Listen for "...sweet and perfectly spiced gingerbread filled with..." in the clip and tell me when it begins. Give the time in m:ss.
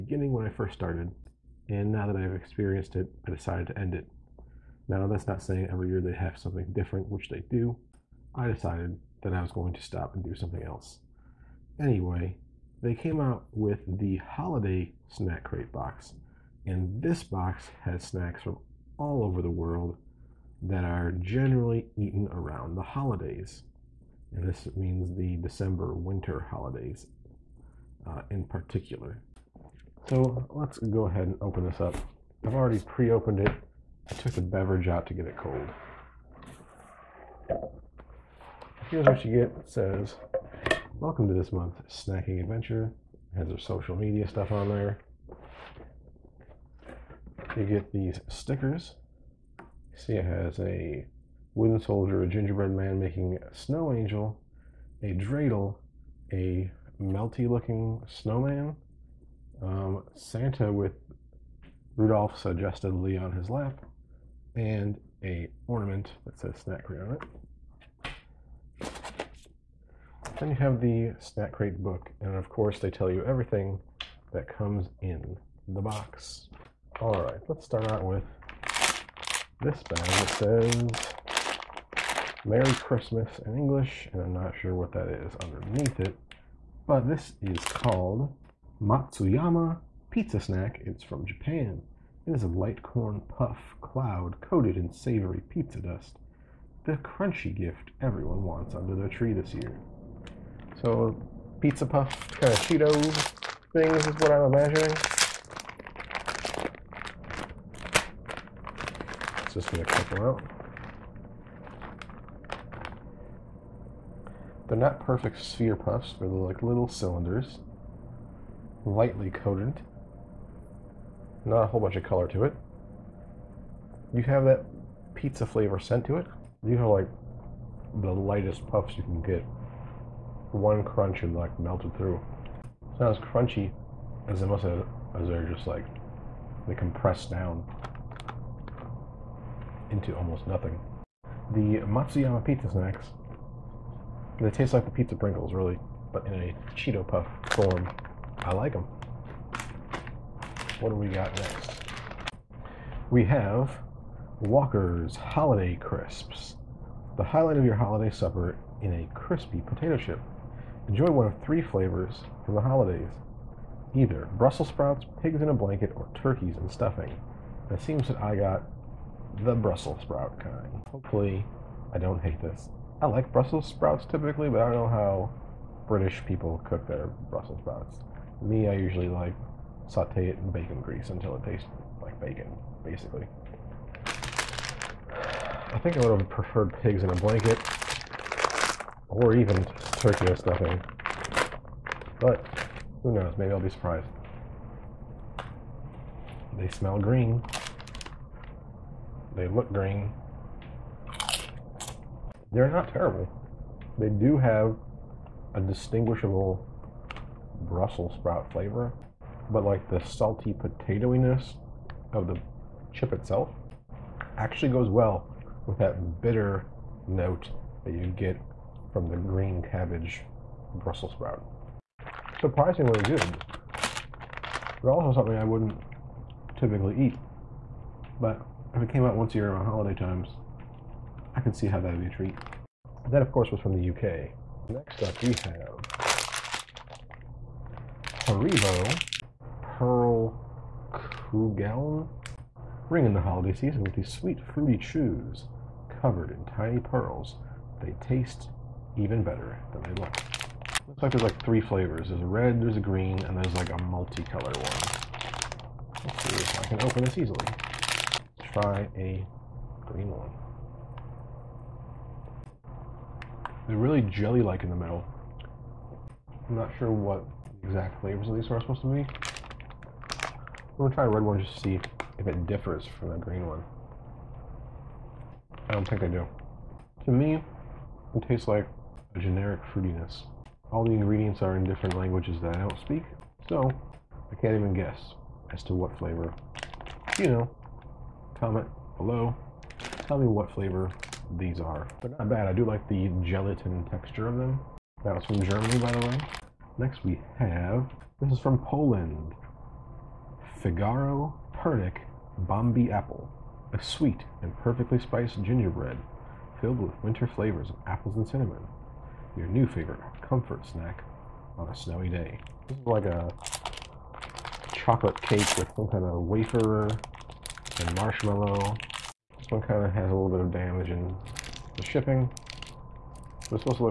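5:03.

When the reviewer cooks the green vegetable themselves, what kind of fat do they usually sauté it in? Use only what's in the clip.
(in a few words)
bacon grease.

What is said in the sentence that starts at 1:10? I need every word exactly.
Then you have the snack crate book, and of course they tell you everything that comes in the box.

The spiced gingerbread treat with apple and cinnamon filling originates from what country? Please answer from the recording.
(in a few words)
Poland.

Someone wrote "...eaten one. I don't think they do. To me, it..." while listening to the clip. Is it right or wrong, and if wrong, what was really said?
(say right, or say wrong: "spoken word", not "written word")
wrong: "green", not "eaten".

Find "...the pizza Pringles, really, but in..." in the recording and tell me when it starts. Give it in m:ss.
2:24.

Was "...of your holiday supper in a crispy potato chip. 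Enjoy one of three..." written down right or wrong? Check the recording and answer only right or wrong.
right.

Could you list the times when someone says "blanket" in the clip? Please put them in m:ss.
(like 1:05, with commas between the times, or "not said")
2:45, 3:07.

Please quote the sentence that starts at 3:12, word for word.
But, who knows, maybe I'll be surprised.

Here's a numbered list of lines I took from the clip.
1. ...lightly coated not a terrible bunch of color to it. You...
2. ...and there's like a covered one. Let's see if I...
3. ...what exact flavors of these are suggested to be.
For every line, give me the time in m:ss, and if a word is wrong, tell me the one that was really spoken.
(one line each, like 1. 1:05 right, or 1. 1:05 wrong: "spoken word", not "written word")
1. 1:58 wrong: "whole", not "terrible"
2. 4:13 wrong: "multicolored", not "covered"
3. 4:26 wrong: "supposed", not "suggested".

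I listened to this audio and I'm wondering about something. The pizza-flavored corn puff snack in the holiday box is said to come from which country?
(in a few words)
Japan.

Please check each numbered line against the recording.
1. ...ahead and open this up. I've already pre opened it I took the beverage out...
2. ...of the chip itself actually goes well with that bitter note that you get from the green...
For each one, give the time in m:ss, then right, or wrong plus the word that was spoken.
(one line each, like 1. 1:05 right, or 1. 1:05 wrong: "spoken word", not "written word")
1. 0:31 right
2. 3:32 right.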